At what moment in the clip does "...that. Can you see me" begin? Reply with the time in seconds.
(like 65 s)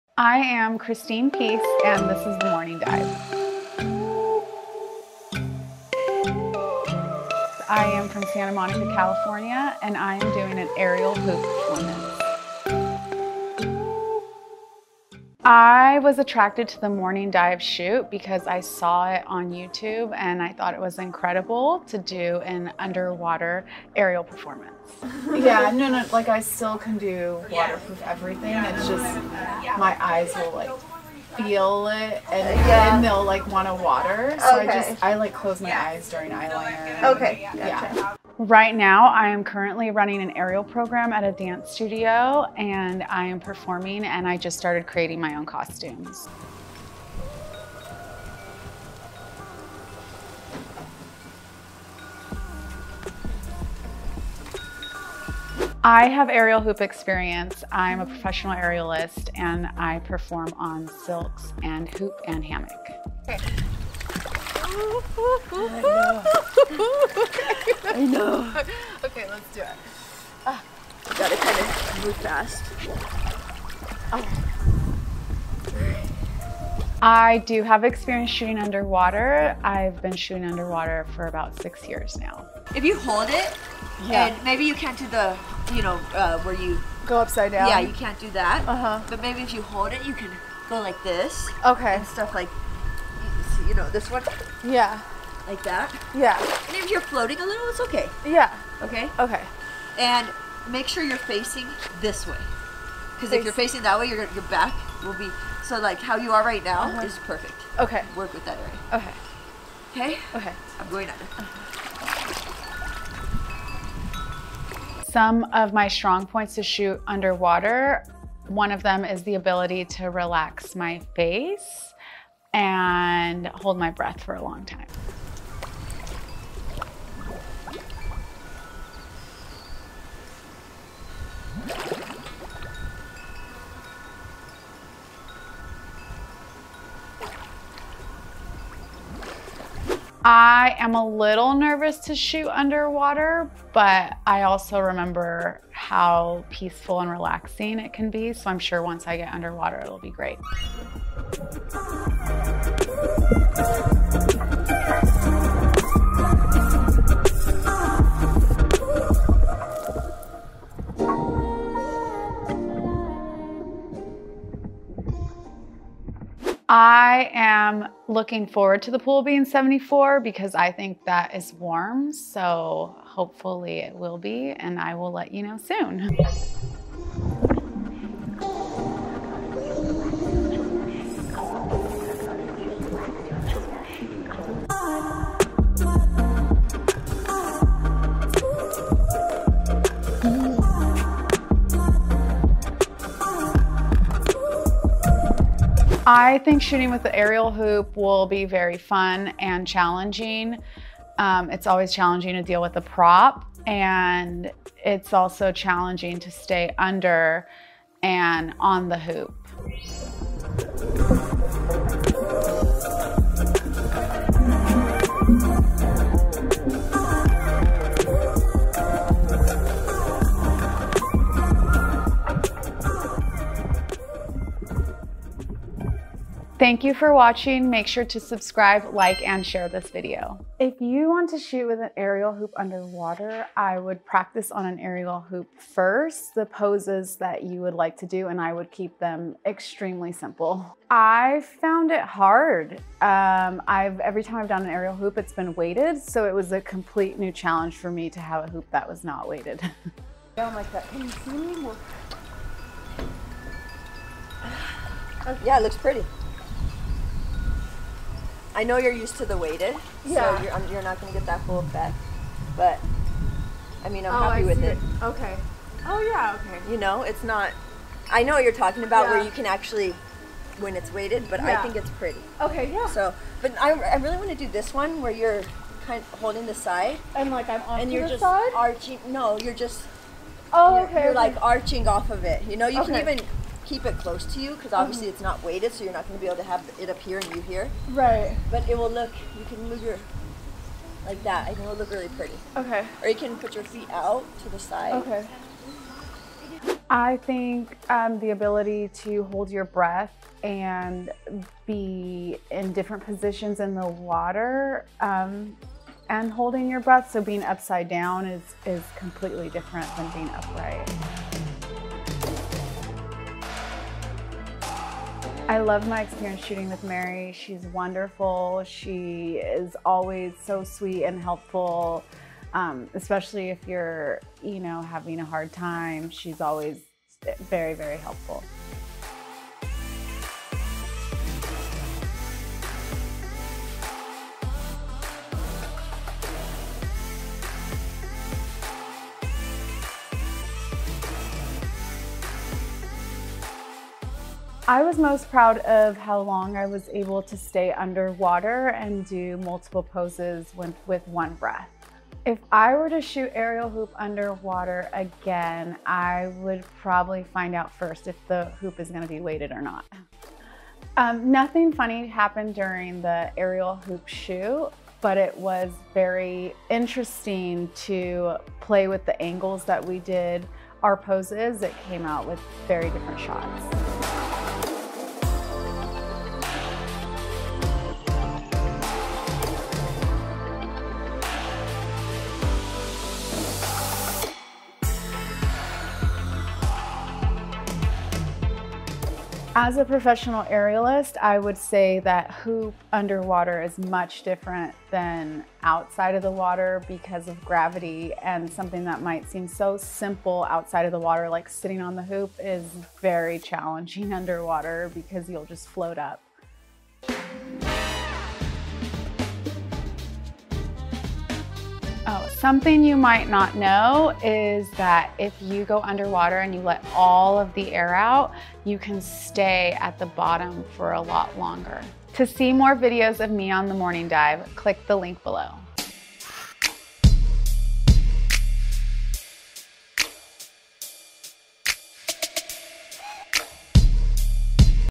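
250 s.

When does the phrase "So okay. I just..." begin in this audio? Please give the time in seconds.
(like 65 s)
34 s.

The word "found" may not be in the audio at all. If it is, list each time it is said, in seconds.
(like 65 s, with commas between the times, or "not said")
241 s.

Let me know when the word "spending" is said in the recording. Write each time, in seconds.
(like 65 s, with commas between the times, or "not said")
not said.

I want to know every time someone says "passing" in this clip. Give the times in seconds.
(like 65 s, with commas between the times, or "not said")
not said.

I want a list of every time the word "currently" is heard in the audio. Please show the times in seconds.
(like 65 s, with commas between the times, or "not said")
39 s.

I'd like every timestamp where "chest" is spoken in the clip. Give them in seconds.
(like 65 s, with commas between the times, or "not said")
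not said.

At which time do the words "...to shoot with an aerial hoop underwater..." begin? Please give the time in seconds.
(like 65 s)
231 s.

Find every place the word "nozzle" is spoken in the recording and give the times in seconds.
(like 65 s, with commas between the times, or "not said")
not said.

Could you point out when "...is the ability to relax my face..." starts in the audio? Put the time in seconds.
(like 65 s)
119 s.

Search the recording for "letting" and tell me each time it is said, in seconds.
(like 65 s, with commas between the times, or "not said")
not said.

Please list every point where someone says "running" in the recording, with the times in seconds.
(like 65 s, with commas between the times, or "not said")
39 s.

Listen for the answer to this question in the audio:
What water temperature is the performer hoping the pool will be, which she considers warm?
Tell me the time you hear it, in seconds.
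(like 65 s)
169 s.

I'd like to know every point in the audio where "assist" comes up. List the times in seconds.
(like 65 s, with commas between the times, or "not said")
not said.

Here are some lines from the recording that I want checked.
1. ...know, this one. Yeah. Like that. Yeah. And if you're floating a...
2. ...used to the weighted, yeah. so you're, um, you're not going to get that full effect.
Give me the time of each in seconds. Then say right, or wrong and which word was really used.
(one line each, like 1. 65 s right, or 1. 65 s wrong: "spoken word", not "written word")
1. 93 s right
2. 258 s right.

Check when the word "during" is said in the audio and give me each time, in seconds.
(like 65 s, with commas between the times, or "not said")
36 s, 362 s.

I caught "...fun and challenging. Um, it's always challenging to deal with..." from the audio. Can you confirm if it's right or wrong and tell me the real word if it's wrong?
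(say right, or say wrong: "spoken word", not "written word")
right.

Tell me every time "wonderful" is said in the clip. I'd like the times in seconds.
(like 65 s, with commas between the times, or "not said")
317 s.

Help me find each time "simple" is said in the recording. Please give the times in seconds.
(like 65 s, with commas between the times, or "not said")
240 s, 399 s.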